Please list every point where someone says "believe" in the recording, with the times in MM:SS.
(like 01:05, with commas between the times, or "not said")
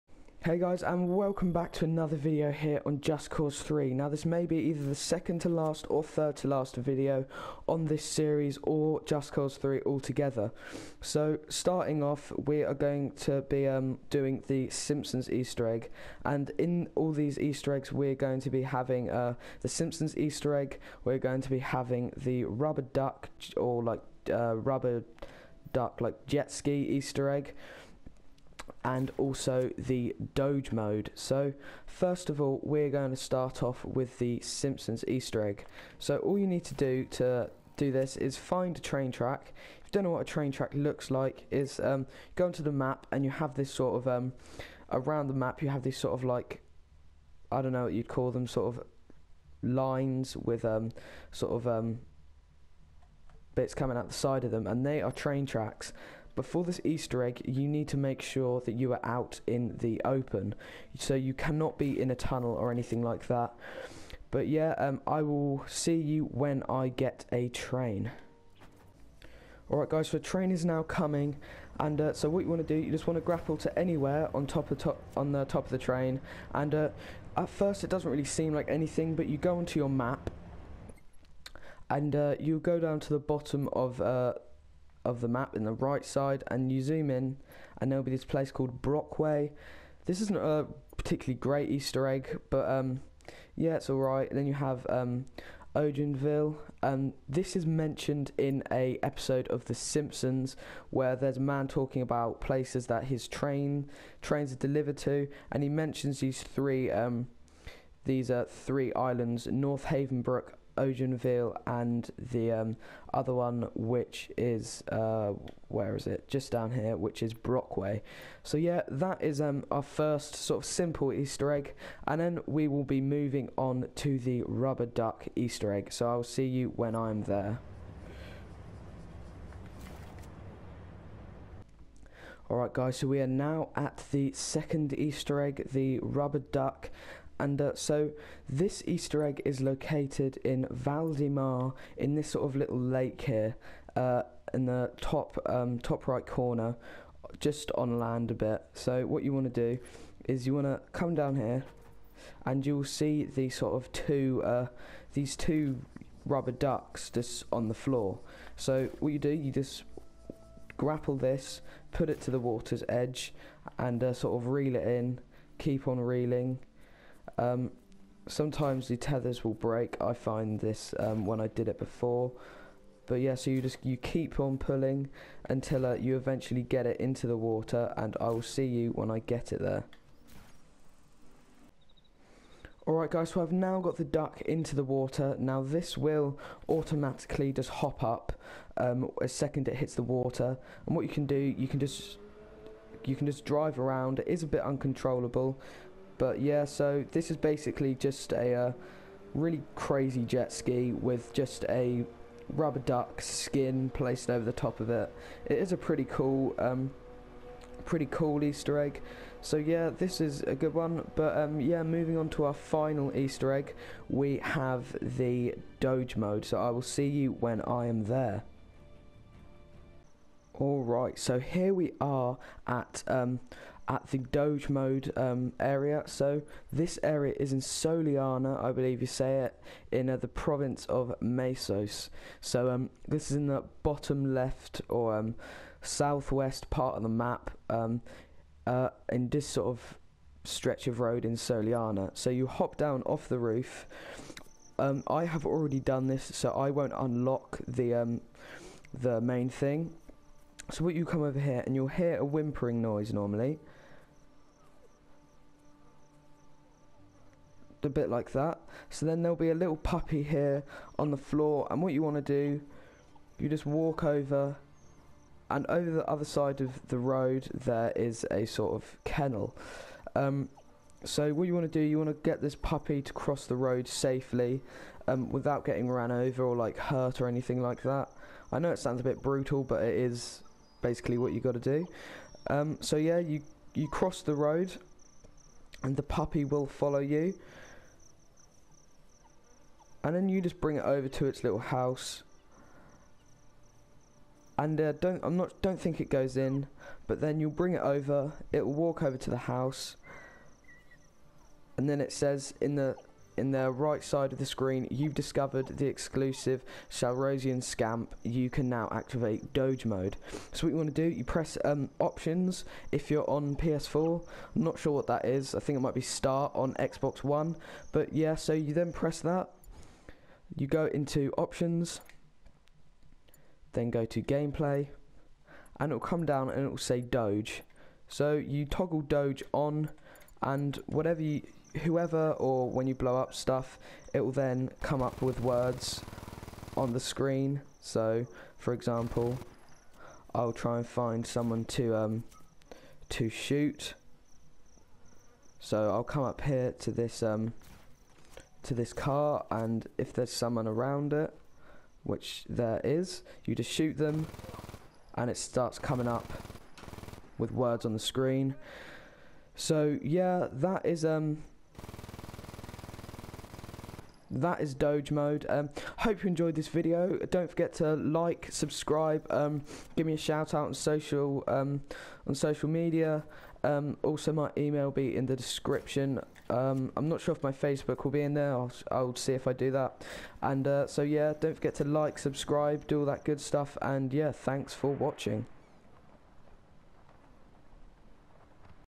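03:48.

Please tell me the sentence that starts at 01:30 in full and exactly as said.
This isn't a particularly great Easter egg, but um, yeah, it's alright.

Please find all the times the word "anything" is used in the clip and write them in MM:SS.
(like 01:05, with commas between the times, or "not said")
01:02, 01:18, 04:37.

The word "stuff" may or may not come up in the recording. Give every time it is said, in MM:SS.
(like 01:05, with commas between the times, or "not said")
05:33, 06:23.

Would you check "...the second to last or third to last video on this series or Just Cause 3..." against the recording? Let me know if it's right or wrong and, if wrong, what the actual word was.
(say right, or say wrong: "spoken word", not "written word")
right.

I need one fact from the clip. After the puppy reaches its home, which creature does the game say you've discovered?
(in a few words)
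Salrosian Scamp.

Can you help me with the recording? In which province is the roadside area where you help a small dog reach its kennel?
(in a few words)
Mesos.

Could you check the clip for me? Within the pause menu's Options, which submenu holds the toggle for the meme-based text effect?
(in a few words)
Gameplay.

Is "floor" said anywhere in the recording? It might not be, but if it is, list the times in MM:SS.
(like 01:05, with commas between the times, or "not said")
02:37, 04:21.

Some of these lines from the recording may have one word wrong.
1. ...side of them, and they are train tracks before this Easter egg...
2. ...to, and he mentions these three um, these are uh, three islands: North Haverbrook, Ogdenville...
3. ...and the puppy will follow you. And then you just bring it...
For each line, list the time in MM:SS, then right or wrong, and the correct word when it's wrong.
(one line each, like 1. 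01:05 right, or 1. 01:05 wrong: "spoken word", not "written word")
1. 00:54 right
2. 01:44 right
3. 04:45 right.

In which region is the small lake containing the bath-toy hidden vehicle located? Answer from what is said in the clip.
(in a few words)
Val Mar.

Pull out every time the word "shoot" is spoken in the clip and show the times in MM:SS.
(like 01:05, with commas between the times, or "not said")
05:43, 05:53.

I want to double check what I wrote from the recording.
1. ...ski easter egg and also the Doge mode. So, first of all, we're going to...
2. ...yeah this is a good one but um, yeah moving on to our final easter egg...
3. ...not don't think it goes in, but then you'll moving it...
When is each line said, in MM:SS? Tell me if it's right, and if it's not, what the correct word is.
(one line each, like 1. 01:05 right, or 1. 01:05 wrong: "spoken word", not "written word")
1. 00:26 right
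2. 03:29 right
3. 04:55 wrong: "bring", not "moving".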